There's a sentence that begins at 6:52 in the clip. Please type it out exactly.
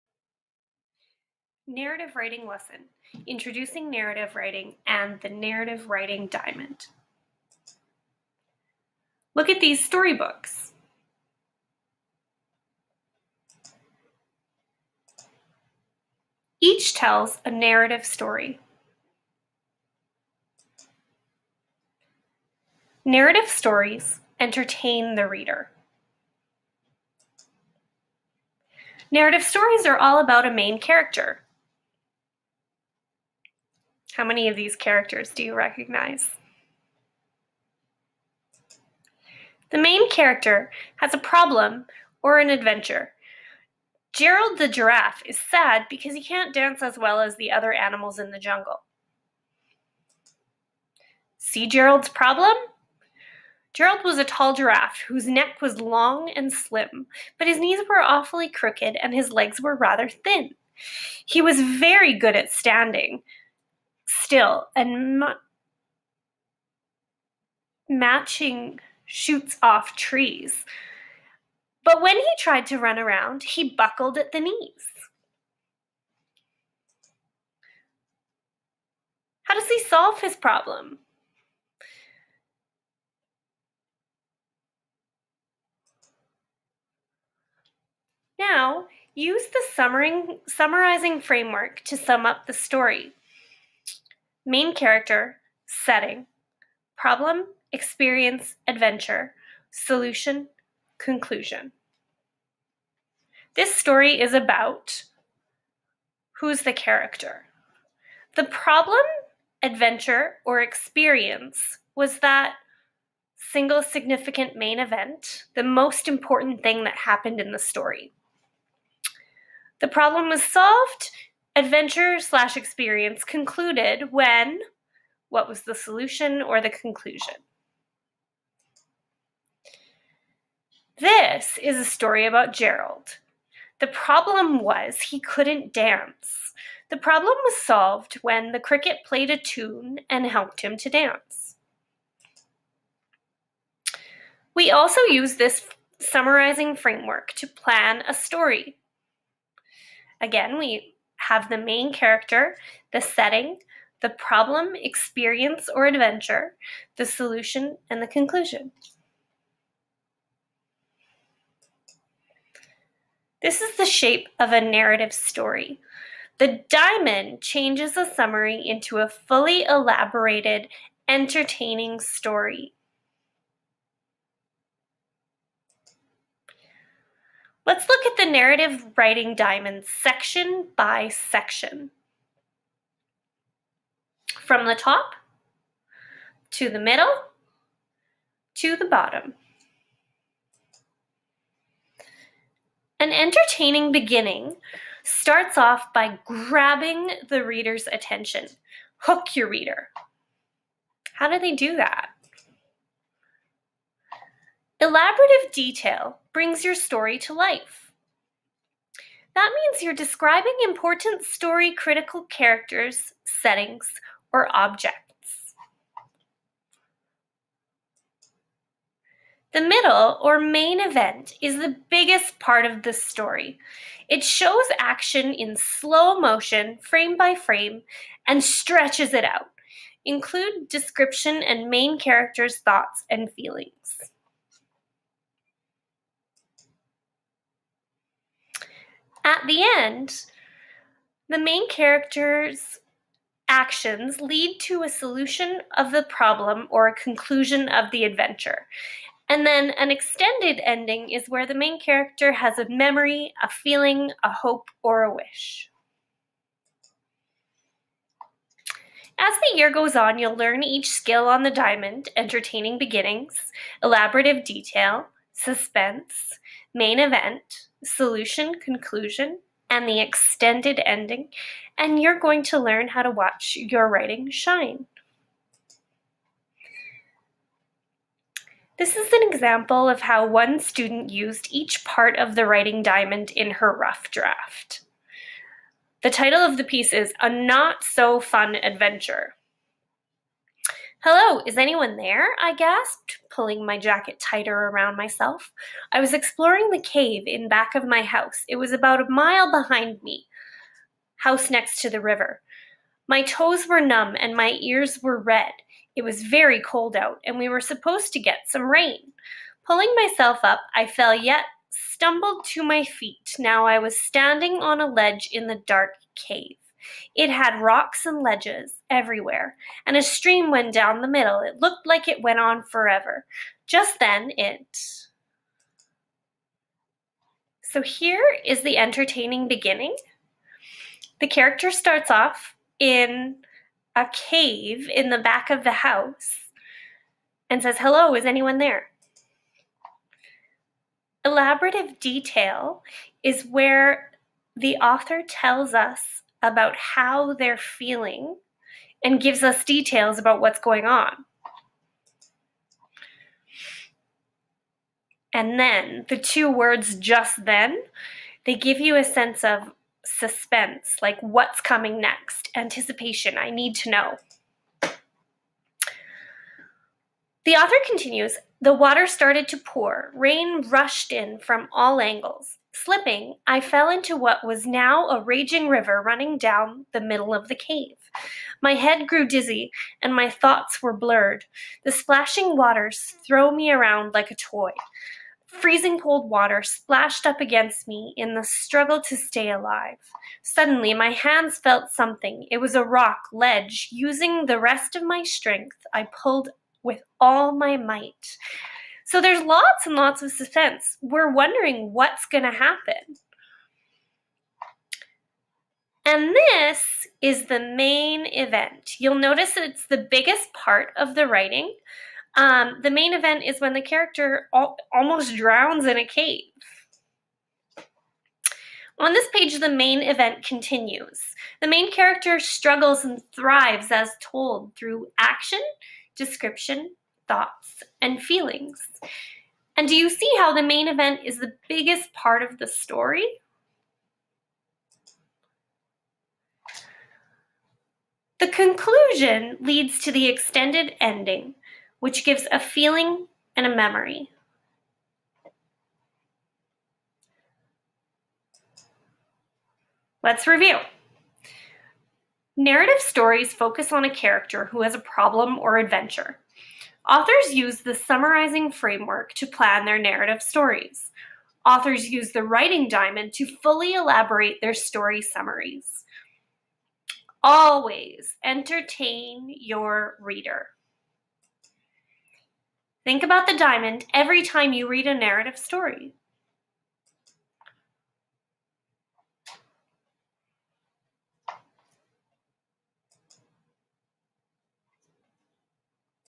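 Um, the main event is when the character al- almost drowns in a cave.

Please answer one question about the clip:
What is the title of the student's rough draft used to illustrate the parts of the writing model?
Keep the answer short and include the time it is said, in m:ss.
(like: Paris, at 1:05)
A Not So Fun Adventure, at 4:47.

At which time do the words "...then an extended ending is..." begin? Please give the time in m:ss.
4:09.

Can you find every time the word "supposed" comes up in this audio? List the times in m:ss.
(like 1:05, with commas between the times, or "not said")
5:07.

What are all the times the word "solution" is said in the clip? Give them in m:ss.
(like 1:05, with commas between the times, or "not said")
1:39, 2:05, 2:37, 4:04, 4:27.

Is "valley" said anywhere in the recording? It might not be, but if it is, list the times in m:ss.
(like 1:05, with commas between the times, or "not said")
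not said.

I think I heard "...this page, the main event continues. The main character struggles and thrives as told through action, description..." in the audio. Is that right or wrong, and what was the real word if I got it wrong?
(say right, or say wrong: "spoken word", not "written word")
right.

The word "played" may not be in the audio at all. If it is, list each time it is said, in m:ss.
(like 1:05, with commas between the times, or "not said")
2:19.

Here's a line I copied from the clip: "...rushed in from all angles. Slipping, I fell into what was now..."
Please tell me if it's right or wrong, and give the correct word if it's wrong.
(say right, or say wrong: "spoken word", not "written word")
right.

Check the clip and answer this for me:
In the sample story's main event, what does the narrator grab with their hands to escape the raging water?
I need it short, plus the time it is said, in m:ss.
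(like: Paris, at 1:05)
A rock ledge, at 6:32.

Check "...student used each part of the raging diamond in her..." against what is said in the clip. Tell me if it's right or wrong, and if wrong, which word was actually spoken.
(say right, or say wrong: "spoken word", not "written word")
wrong: "writing", not "raging".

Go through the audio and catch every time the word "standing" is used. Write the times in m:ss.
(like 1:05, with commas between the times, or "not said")
1:02, 5:13.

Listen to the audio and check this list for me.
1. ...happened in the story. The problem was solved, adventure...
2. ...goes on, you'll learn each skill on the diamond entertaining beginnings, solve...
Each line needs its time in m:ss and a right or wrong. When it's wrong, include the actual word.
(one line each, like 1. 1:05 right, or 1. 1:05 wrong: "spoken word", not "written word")
1. 1:56 right
2. 4:19 wrong: "elaborative", not "solve".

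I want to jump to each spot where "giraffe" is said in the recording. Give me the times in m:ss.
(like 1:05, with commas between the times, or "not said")
0:44, 0:54.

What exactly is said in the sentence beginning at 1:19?
How does he solve his problem?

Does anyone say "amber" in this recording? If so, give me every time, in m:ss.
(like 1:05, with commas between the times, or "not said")
not said.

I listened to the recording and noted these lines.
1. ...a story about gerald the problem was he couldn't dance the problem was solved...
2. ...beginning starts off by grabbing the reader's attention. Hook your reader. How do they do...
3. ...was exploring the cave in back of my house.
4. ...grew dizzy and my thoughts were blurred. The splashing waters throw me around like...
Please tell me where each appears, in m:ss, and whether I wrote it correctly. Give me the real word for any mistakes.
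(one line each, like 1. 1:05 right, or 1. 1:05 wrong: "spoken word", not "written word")
1. 2:11 right
2. 3:13 right
3. 4:55 right
4. 6:19 right.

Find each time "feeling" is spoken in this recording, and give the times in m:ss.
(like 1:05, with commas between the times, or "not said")
3:53, 4:13, 5:47, 7:08, 7:22.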